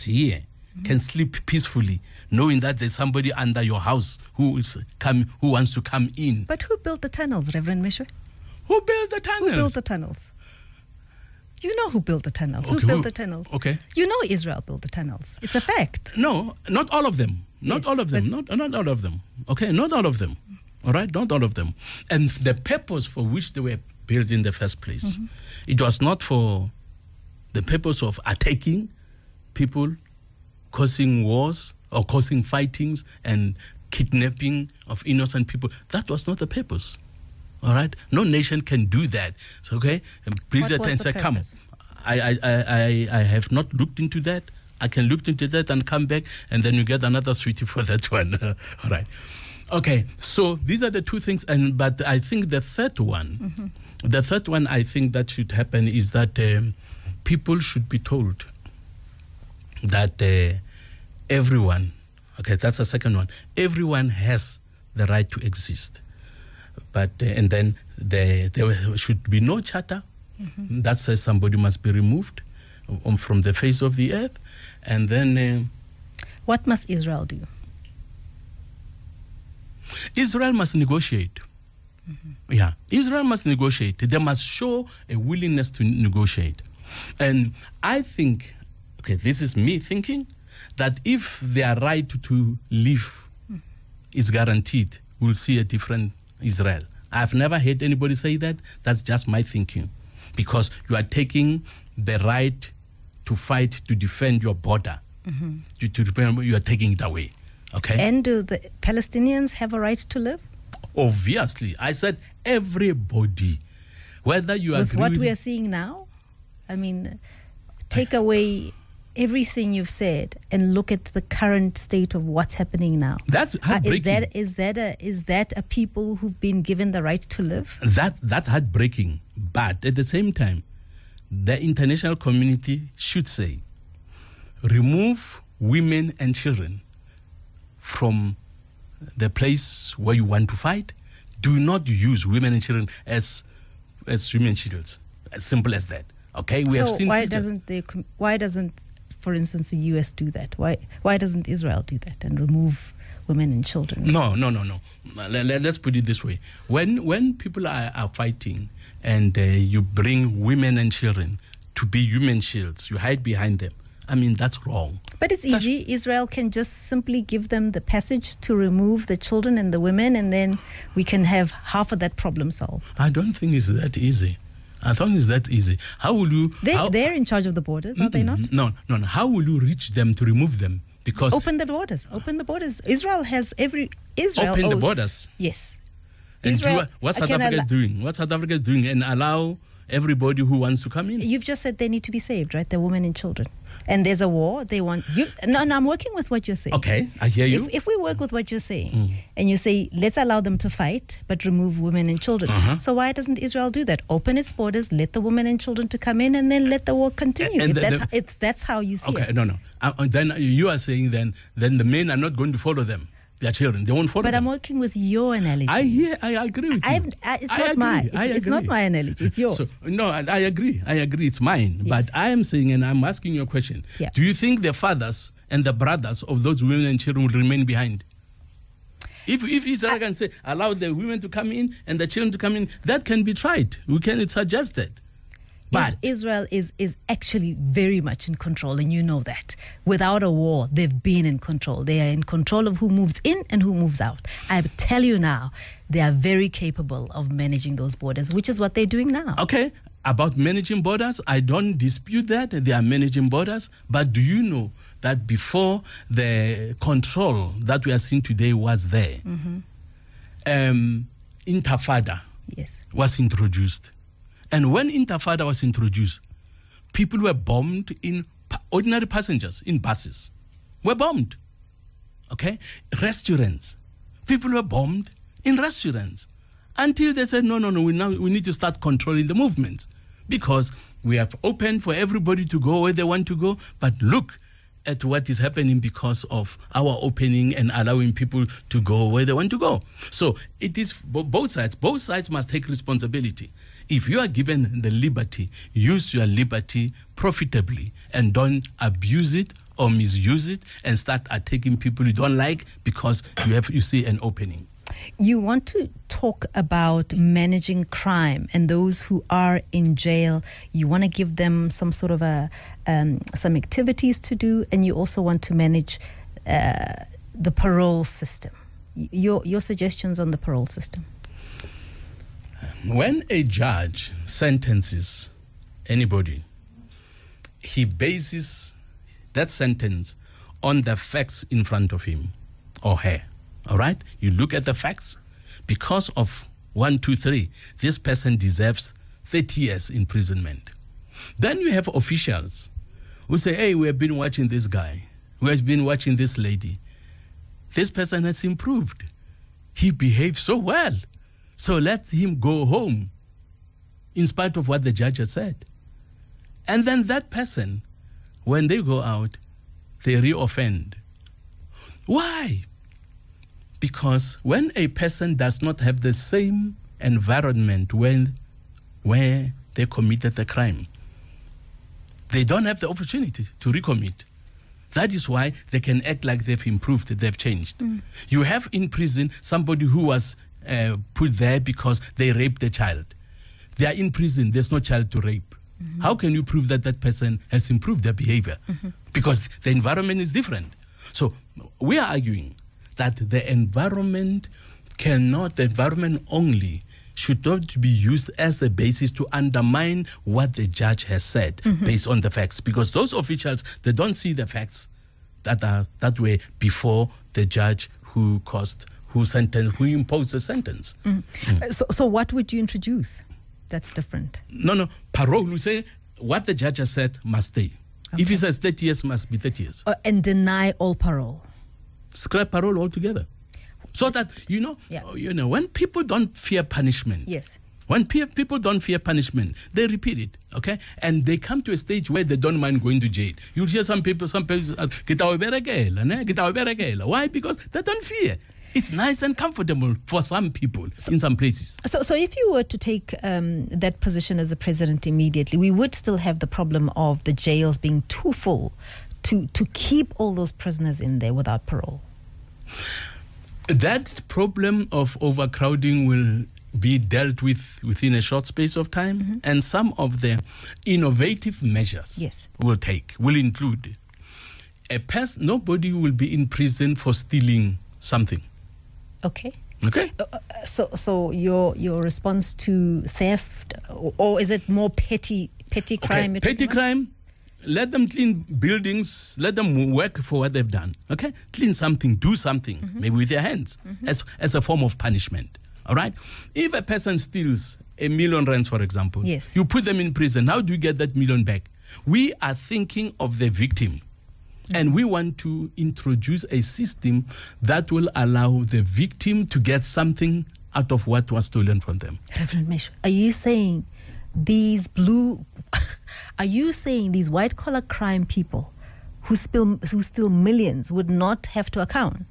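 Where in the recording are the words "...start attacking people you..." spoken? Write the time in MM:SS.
05:00.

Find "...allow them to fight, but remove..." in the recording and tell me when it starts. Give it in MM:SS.
03:20.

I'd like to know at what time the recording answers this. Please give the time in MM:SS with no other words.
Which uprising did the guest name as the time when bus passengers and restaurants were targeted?
04:24.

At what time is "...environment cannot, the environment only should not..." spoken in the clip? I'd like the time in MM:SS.
06:33.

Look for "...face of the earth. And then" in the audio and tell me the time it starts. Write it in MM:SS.
01:13.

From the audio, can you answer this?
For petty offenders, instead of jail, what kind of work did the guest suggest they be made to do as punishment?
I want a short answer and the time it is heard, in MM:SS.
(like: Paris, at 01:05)
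Clean buildings, at 07:58.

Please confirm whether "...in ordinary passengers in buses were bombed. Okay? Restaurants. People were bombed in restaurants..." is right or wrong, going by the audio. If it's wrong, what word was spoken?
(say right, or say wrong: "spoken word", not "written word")
right.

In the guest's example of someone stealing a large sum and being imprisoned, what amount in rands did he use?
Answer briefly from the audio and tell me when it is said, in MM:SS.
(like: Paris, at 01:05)
A million rands, at 08:07.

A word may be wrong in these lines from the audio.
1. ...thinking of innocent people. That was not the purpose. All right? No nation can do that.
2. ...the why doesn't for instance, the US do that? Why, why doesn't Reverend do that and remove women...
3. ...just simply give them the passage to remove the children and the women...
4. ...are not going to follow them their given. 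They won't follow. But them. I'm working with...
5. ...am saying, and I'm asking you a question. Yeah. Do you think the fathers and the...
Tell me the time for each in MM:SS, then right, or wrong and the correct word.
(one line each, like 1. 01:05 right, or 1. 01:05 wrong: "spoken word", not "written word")
1. 00:33 wrong: "kidnapping", not "thinking"
2. 02:27 wrong: "Israel", not "Reverend"
3. 02:46 right
4. 03:32 wrong: "children", not "given"
5. 03:42 right.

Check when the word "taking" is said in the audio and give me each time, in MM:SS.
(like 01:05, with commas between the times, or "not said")
01:41, 01:46.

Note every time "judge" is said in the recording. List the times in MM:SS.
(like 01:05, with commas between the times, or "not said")
05:23, 05:54, 06:40, 06:47, 06:56.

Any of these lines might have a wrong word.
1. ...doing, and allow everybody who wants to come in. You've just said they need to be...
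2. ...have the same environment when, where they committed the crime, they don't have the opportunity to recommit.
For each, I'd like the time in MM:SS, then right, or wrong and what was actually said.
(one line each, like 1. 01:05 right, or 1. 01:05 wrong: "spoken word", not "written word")
1. 03:08 right
2. 06:05 right.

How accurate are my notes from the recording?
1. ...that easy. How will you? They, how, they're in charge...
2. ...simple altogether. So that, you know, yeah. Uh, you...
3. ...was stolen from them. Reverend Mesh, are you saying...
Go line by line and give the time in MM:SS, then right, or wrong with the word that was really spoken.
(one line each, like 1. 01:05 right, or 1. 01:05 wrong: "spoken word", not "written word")
1. 02:55 right
2. 07:02 wrong: "parole", not "simple"
3. 08:21 right.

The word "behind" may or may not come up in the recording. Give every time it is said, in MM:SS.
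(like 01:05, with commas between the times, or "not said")
02:43, 03:47.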